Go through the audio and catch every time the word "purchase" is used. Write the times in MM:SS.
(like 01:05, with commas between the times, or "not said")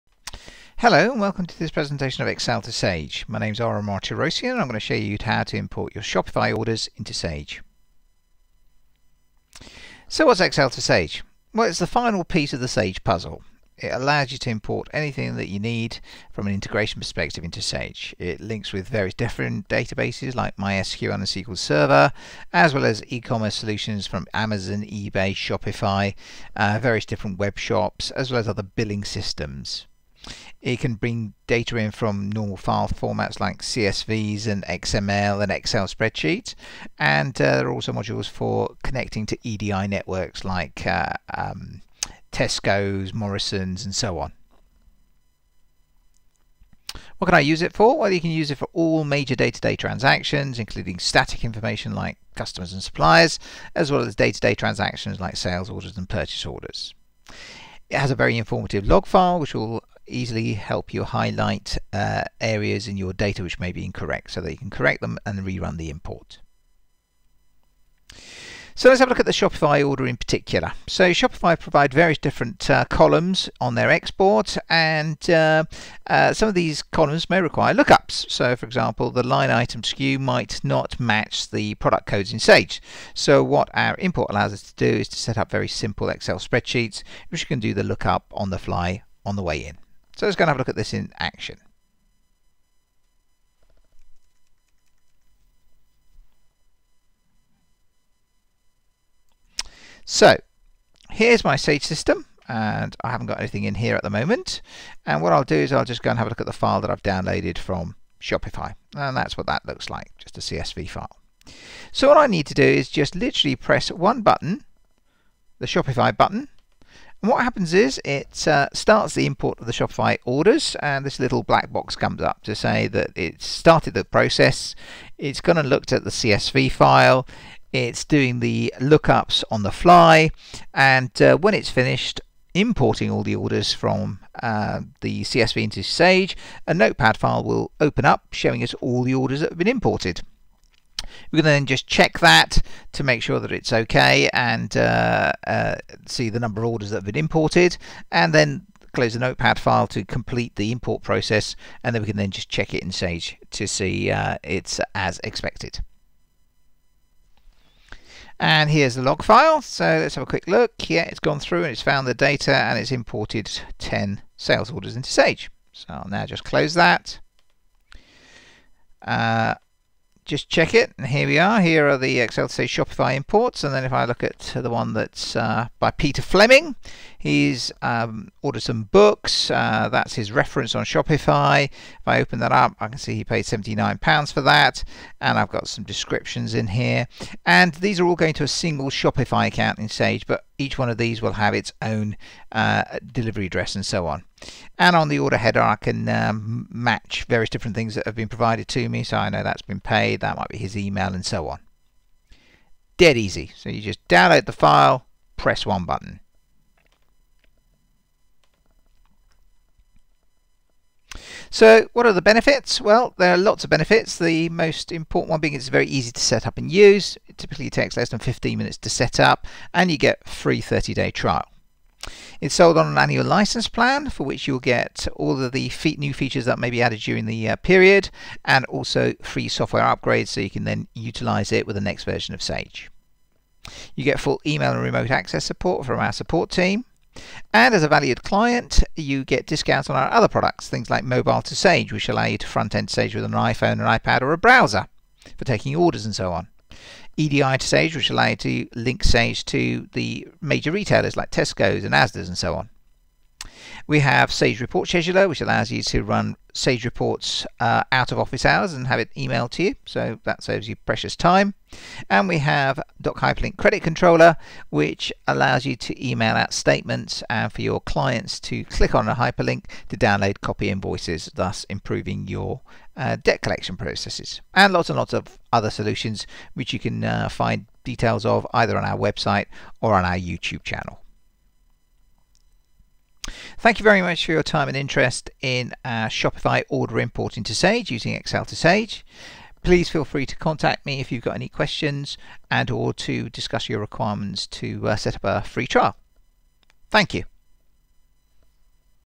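00:56.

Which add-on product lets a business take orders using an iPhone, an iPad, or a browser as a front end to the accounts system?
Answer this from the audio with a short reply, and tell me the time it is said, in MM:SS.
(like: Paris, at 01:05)
Mobile to Sage, at 04:01.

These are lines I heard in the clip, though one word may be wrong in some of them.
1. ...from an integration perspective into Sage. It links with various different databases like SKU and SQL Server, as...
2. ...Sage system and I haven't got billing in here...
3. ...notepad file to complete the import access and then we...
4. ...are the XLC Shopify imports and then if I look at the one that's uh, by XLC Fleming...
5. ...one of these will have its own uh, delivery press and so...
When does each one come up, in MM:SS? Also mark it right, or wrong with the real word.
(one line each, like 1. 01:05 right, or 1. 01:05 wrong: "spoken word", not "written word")
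1. 00:16 wrong: "MySQL", not "SKU"
2. 01:41 wrong: "anything", not "billing"
3. 02:29 wrong: "process", not "access"
4. 02:51 wrong: "Peter", not "XLC"
5. 03:10 wrong: "address", not "press".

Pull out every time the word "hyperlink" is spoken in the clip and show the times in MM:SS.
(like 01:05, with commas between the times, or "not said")
04:23, 04:29.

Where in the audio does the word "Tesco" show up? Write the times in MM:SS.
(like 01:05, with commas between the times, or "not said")
00:42, 04:11.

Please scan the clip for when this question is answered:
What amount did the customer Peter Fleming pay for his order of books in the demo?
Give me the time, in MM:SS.
03:03.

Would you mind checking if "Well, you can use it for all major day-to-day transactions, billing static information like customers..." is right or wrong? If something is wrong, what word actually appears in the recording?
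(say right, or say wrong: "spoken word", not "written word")
wrong: "including", not "billing".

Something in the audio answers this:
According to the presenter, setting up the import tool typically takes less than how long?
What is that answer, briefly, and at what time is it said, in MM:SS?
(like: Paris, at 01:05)
15 minutes, at 03:38.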